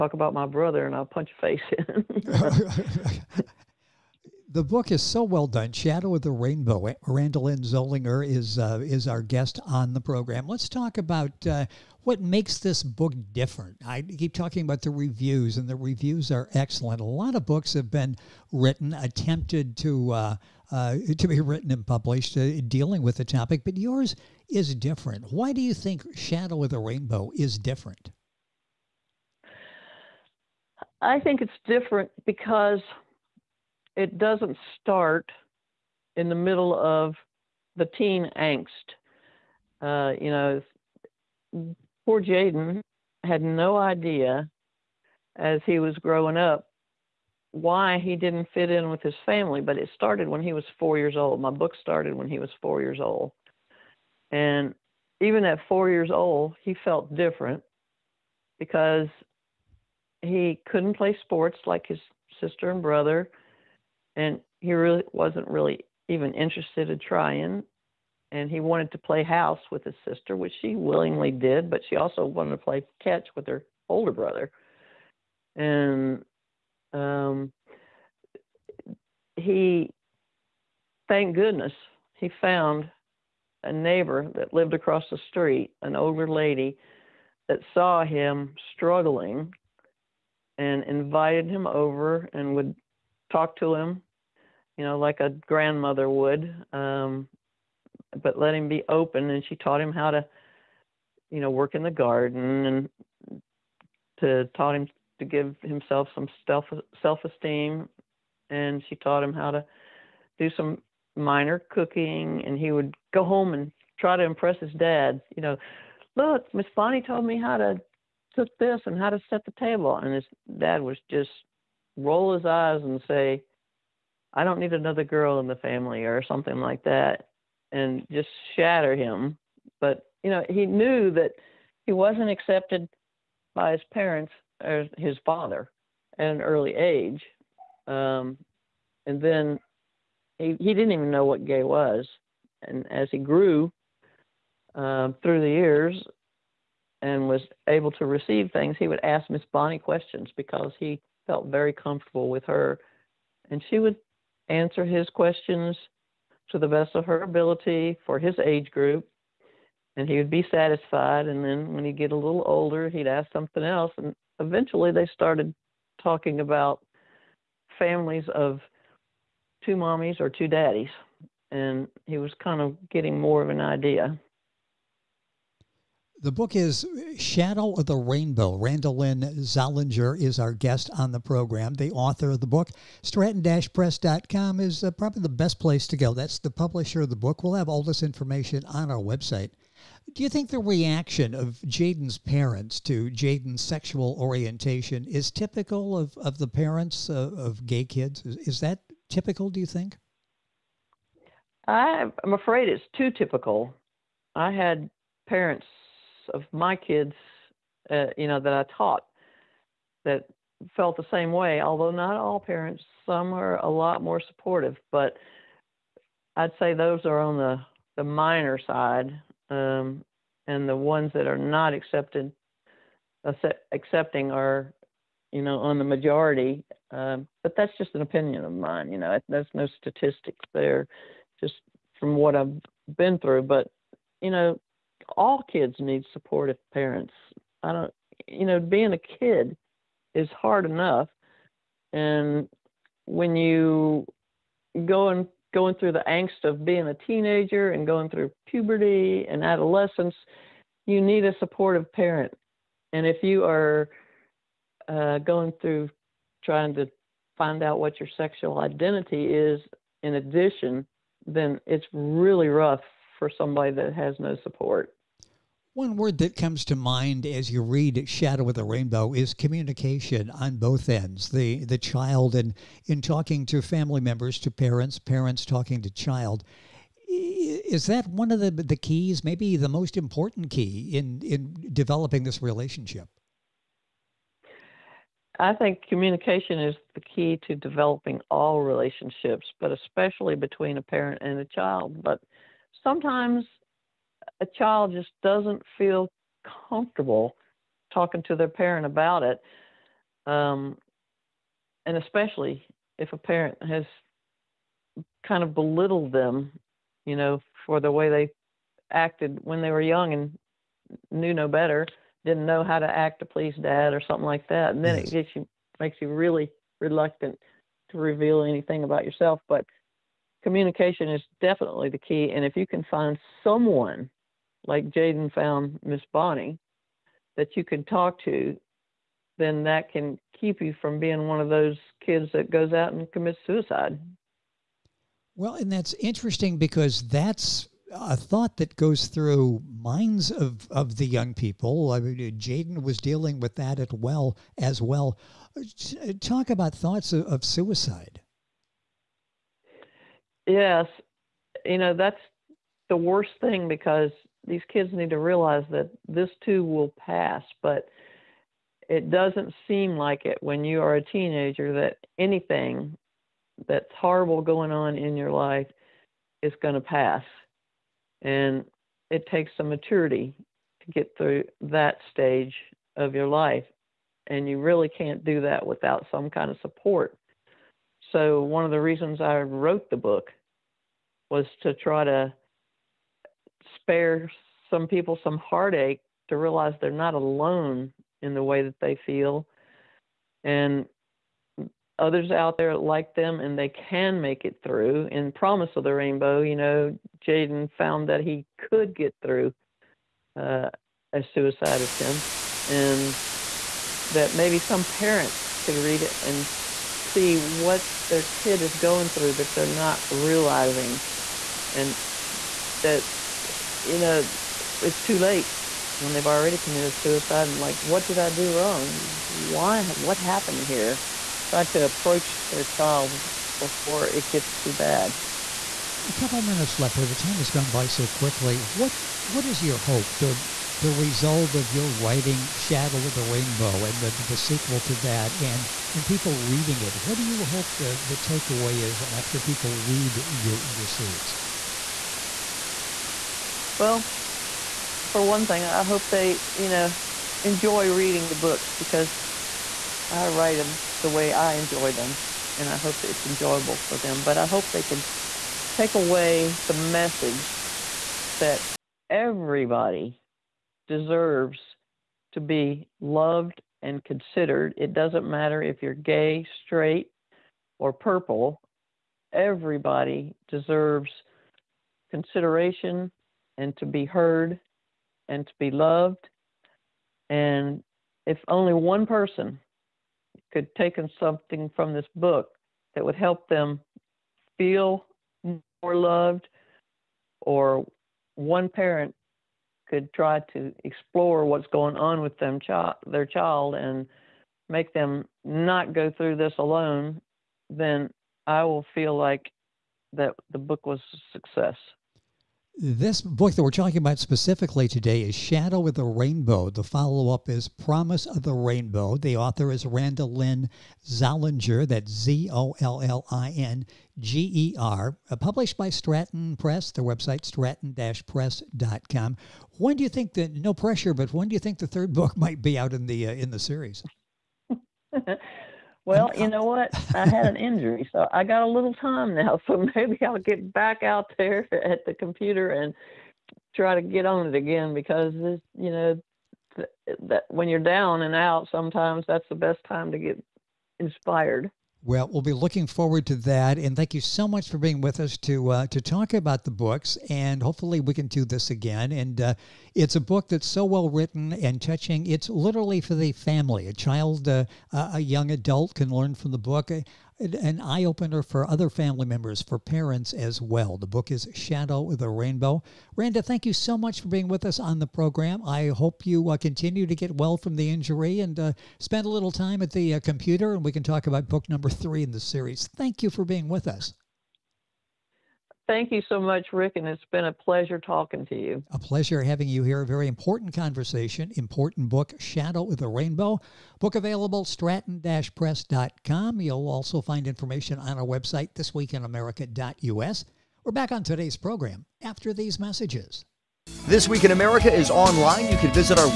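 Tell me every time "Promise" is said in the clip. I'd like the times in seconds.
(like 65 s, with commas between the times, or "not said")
395 s, 507 s.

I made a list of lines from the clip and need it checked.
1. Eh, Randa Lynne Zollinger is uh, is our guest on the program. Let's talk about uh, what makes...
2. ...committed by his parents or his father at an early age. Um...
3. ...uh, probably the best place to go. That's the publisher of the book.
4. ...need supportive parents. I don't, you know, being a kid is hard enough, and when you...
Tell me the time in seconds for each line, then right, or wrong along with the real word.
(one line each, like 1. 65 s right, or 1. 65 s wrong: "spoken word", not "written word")
1. 6 s right
2. 132 s wrong: "accepted", not "committed"
3. 184 s right
4. 235 s right.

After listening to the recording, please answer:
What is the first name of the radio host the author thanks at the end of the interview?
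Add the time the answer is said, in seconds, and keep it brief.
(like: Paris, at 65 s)
Ric, at 576 s.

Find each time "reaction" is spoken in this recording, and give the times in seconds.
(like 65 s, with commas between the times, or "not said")
190 s.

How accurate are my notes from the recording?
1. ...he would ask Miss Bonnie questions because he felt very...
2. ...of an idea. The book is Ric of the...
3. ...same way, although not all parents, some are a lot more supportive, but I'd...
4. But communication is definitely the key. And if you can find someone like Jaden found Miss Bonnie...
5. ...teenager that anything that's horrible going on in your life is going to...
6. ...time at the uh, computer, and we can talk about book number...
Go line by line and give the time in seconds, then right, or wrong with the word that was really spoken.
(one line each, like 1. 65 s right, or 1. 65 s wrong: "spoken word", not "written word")
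1. 148 s right
2. 173 s wrong: "Shadow", not "Ric"
3. 211 s right
4. 319 s right
5. 361 s right
6. 569 s right.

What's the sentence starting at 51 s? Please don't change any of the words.
My book started when he was four years old.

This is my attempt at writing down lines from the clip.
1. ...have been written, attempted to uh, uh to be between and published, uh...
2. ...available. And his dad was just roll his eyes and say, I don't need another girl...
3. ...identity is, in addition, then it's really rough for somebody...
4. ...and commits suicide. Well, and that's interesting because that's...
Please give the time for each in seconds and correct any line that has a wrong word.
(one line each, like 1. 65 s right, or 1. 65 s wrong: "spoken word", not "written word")
1. 17 s wrong: "written", not "between"
2. 119 s wrong: "table", not "available"
3. 258 s right
4. 332 s right.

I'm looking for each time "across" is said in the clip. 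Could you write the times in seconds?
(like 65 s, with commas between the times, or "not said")
84 s.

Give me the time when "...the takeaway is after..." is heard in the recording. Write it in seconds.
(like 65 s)
438 s.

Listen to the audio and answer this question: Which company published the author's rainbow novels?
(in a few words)
Stratton Press.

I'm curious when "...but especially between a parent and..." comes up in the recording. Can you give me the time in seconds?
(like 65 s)
289 s.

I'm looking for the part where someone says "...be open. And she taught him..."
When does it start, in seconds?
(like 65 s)
98 s.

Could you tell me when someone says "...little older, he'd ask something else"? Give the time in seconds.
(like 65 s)
162 s.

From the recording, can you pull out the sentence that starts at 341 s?
I mean, Jaden was dealing with that at well as well.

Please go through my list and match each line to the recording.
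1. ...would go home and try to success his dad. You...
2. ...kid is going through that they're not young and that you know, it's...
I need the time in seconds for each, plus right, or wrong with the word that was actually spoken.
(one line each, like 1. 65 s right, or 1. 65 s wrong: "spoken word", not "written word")
1. 112 s wrong: "impress", not "success"
2. 408 s wrong: "realizing", not "young".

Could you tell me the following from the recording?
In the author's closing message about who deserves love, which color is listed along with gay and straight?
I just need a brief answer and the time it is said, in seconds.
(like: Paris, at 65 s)
Purple, at 467 s.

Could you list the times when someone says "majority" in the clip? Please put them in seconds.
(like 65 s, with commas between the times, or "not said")
225 s.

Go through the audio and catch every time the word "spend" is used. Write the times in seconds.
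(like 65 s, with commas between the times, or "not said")
569 s.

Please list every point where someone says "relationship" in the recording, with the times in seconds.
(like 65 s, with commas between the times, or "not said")
282 s, 288 s.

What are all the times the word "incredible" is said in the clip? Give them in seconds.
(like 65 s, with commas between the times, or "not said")
not said.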